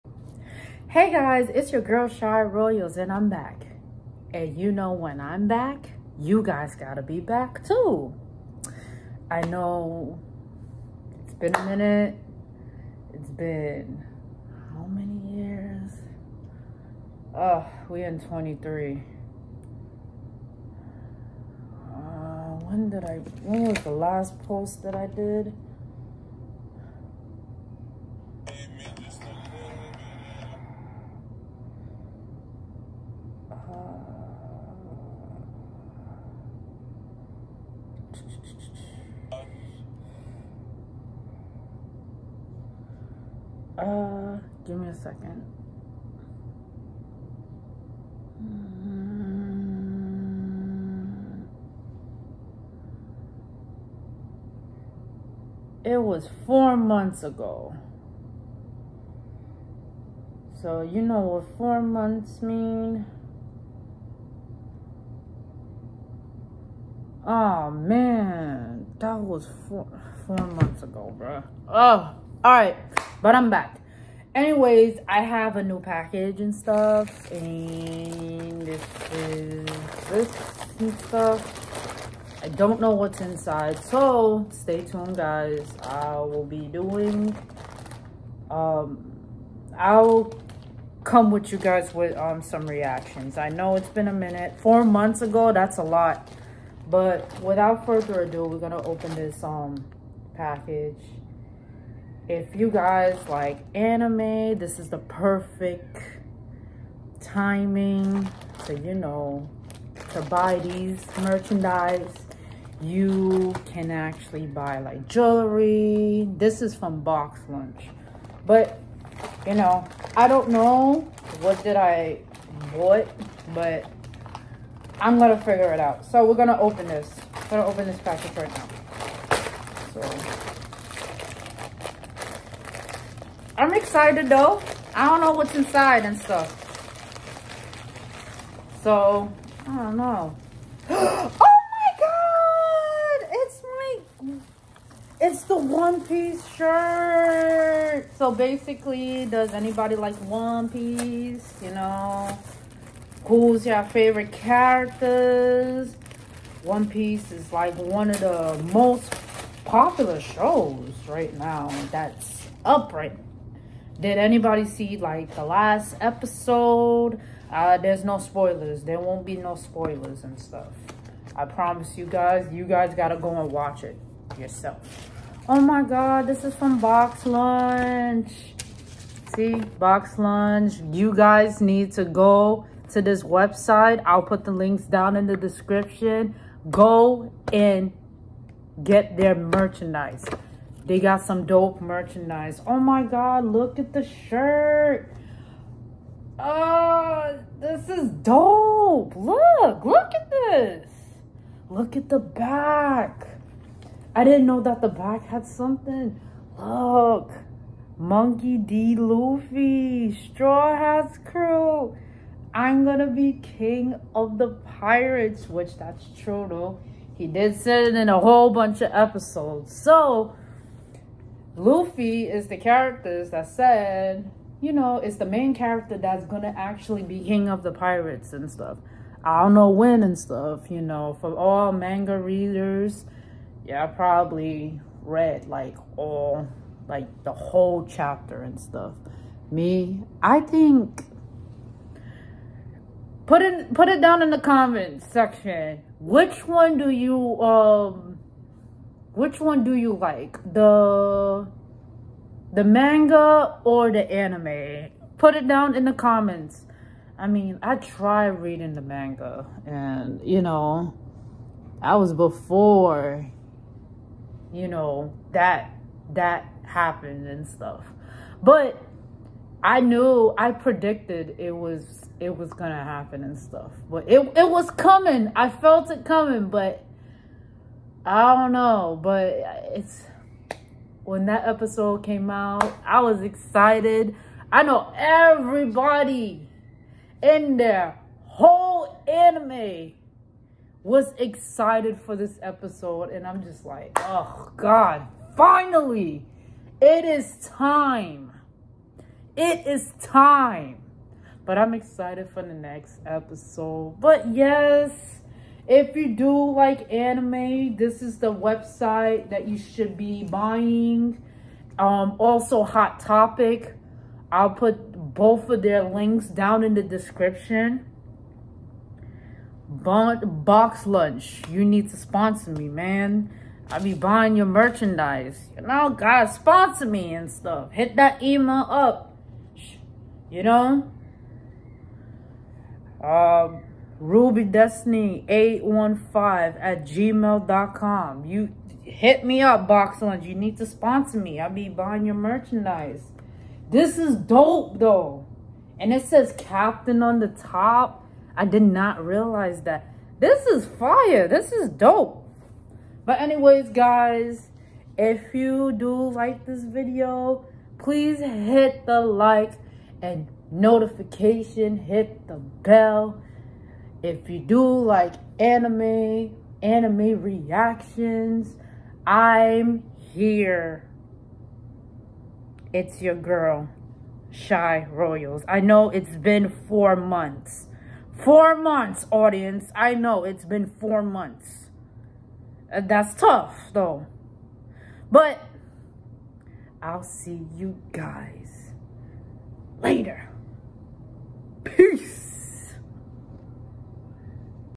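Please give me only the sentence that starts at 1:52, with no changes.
You can actually buy like jewelry.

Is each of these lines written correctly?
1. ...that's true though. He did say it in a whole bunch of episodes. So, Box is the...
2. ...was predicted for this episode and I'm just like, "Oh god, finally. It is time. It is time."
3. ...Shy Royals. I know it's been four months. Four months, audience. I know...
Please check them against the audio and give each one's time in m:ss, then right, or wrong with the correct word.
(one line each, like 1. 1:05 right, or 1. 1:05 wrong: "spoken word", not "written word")
1. 3:35 wrong: "Luffy", not "Box"
2. 4:50 wrong: "excited", not "predicted"
3. 6:14 right.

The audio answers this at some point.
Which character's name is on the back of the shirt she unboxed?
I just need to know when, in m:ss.
3:27.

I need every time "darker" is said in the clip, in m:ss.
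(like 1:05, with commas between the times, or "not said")
not said.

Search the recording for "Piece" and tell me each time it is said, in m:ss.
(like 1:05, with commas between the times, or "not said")
2:26, 2:30, 2:36.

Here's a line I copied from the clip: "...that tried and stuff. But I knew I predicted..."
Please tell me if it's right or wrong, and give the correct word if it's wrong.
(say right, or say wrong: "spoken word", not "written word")
wrong: "happened", not "tried".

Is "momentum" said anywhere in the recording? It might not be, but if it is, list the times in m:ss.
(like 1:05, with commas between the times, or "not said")
not said.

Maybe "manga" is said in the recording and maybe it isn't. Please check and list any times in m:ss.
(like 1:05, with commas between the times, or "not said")
3:51, 4:12, 4:18.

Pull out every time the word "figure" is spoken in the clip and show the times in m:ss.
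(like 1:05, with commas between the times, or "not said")
2:05.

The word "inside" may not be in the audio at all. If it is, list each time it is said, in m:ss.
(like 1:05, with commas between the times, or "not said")
1:23, 2:15.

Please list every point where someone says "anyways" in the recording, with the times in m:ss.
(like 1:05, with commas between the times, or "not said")
1:14, 5:53.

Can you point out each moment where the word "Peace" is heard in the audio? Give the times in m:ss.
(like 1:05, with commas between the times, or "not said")
6:31.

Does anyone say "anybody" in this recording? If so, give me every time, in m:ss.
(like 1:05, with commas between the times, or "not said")
2:29, 2:44.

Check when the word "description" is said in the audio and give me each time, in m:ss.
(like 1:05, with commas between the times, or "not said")
3:05, 5:16.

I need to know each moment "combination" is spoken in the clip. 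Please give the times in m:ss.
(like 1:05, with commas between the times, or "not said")
not said.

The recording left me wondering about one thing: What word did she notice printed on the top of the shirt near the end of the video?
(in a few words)
Captain.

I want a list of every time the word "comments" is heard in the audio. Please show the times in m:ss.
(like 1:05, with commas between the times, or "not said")
4:04, 4:15.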